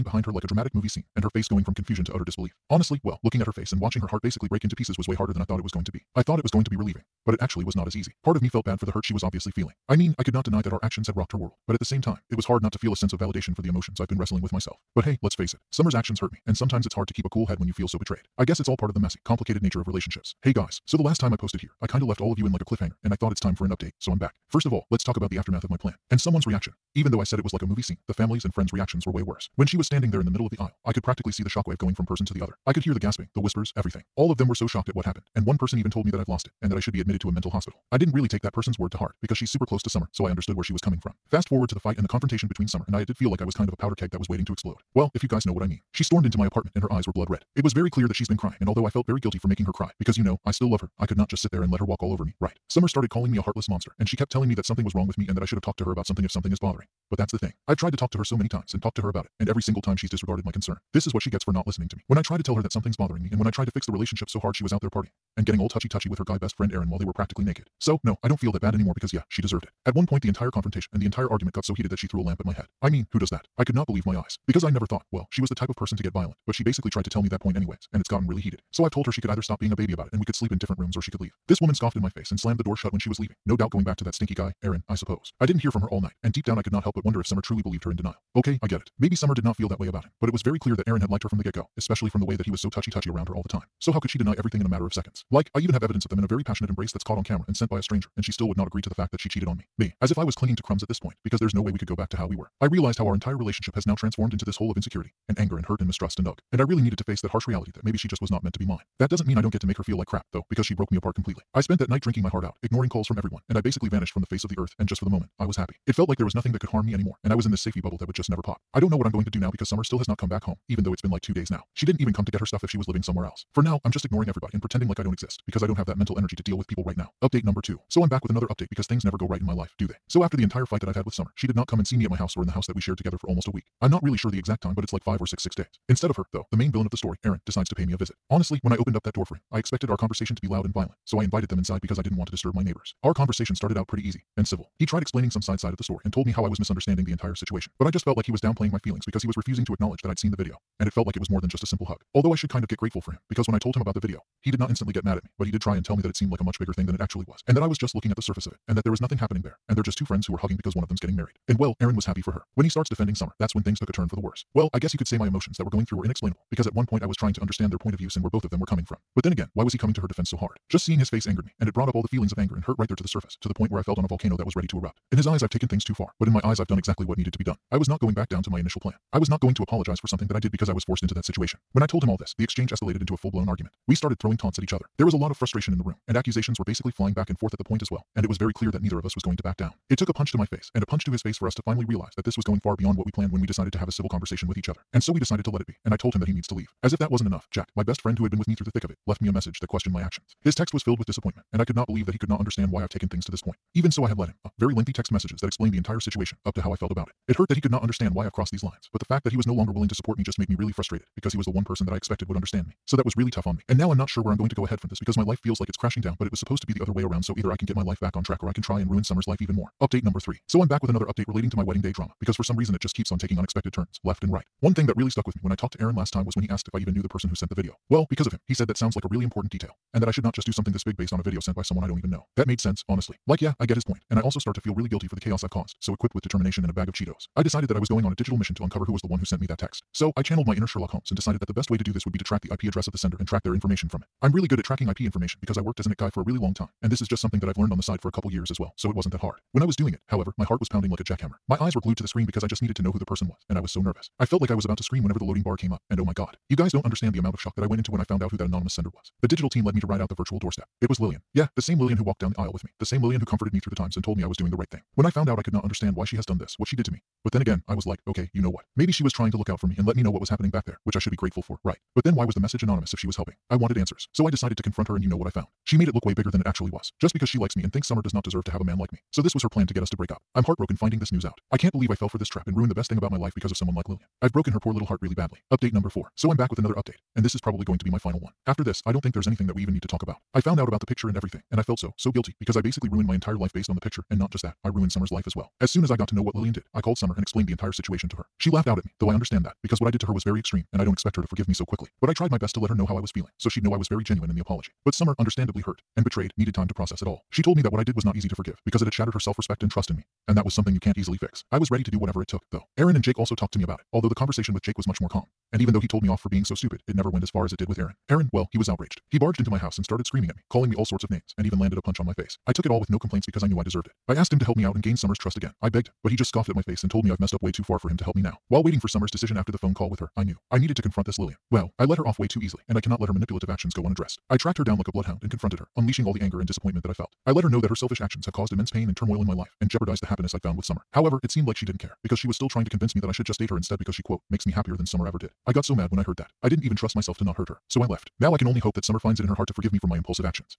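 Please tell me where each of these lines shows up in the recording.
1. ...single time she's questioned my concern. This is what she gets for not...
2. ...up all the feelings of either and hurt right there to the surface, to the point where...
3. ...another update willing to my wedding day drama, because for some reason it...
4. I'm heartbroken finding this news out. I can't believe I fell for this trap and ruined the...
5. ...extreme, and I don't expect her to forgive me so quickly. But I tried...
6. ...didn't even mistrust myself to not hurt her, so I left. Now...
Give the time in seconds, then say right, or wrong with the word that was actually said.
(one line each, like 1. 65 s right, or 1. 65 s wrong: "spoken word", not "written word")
1. 59 s wrong: "disregarded", not "questioned"
2. 171 s wrong: "anger", not "either"
3. 220 s wrong: "relating", not "willing"
4. 280 s right
5. 300 s right
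6. 346 s wrong: "trust", not "mistrust".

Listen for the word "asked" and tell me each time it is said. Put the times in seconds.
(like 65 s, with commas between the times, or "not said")
226 s, 324 s.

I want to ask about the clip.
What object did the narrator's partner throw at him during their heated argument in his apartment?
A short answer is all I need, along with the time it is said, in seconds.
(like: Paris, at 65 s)
A lamp, at 72 s.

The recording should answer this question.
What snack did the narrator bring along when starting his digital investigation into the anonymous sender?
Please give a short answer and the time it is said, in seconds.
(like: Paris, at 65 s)
Cheetos, at 236 s.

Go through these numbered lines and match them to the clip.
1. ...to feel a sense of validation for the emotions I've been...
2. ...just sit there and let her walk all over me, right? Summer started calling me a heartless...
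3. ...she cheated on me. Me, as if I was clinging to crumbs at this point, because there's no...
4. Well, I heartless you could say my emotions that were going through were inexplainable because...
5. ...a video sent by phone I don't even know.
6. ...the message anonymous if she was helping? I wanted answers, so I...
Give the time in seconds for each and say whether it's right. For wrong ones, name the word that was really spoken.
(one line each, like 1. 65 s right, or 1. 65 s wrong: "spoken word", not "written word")
1. 12 s right
2. 51 s right
3. 99 s right
4. 164 s wrong: "guess", not "heartless"
5. 231 s wrong: "someone", not "phone"
6. 272 s right.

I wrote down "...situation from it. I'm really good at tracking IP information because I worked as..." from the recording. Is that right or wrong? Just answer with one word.
wrong.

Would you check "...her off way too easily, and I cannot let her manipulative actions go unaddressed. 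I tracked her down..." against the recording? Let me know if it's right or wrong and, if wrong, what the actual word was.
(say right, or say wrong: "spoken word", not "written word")
right.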